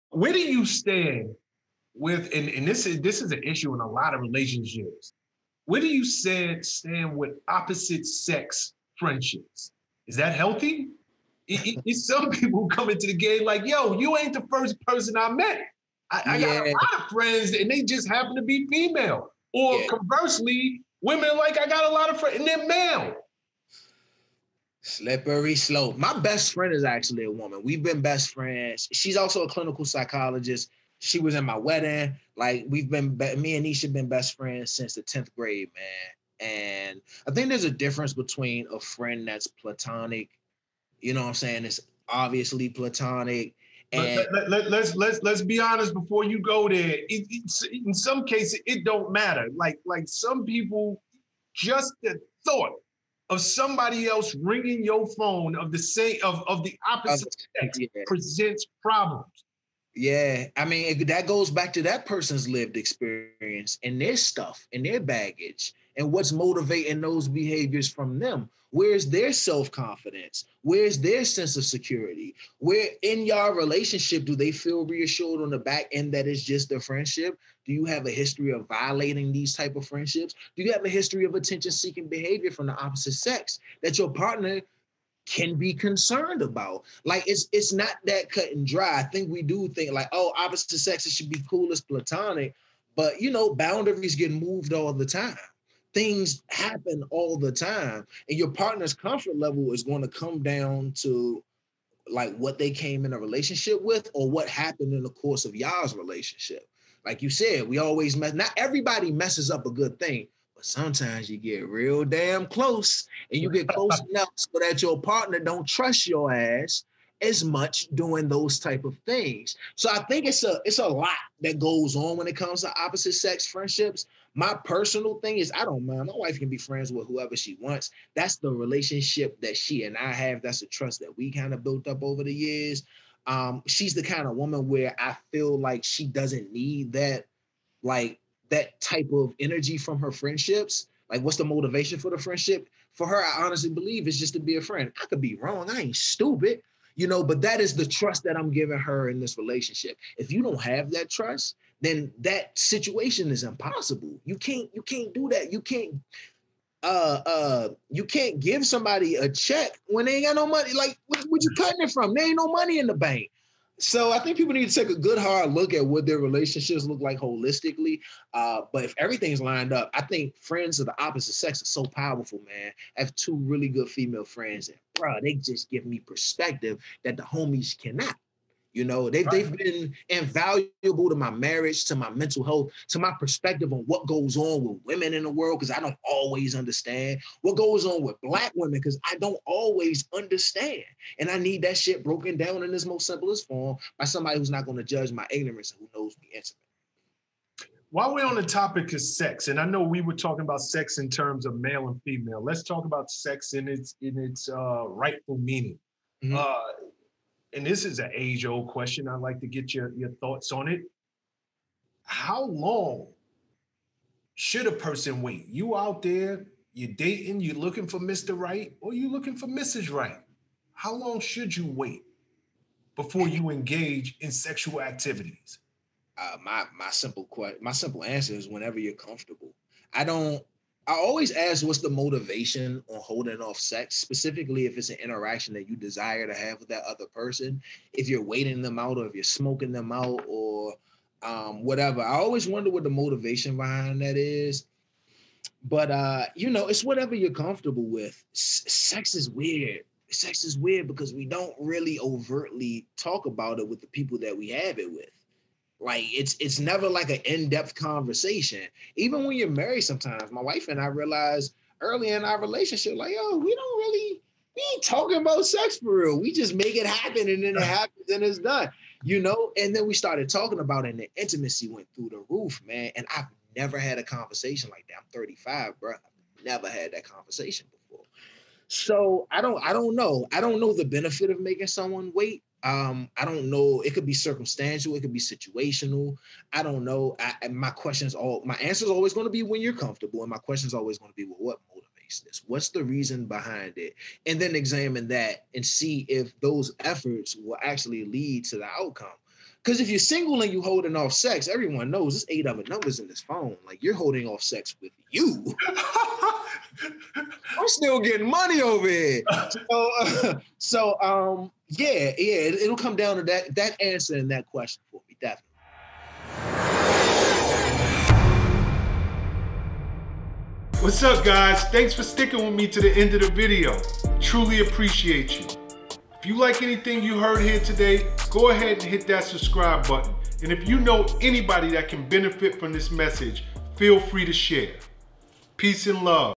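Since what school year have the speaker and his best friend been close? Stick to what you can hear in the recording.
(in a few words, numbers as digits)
Tenth grade.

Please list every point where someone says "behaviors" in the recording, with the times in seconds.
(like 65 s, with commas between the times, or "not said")
67 s, 82 s.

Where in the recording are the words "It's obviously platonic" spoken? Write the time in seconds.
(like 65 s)
41 s.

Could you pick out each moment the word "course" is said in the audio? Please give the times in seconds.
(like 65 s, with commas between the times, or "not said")
105 s.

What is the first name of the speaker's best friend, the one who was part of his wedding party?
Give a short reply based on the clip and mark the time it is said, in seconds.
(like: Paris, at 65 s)
Nisha, at 33 s.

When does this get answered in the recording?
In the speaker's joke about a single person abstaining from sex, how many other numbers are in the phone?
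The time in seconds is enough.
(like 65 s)
302 s.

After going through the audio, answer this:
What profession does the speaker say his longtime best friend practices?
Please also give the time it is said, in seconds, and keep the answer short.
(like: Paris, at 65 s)
Clinical psychologist, at 29 s.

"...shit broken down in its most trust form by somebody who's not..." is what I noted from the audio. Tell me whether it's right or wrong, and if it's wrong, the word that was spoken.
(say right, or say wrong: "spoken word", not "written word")
wrong: "simplest", not "trust".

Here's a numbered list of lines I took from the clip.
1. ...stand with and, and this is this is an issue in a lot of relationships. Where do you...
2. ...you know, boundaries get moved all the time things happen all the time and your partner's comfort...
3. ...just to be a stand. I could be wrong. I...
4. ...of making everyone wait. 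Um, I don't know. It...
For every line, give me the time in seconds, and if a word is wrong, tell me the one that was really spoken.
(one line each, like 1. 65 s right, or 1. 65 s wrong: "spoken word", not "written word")
1. 0 s right
2. 93 s right
3. 144 s wrong: "friend", not "stand"
4. 281 s wrong: "someone", not "everyone".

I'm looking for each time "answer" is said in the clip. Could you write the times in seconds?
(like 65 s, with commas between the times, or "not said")
228 s, 288 s, 313 s.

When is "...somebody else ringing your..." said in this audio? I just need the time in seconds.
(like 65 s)
53 s.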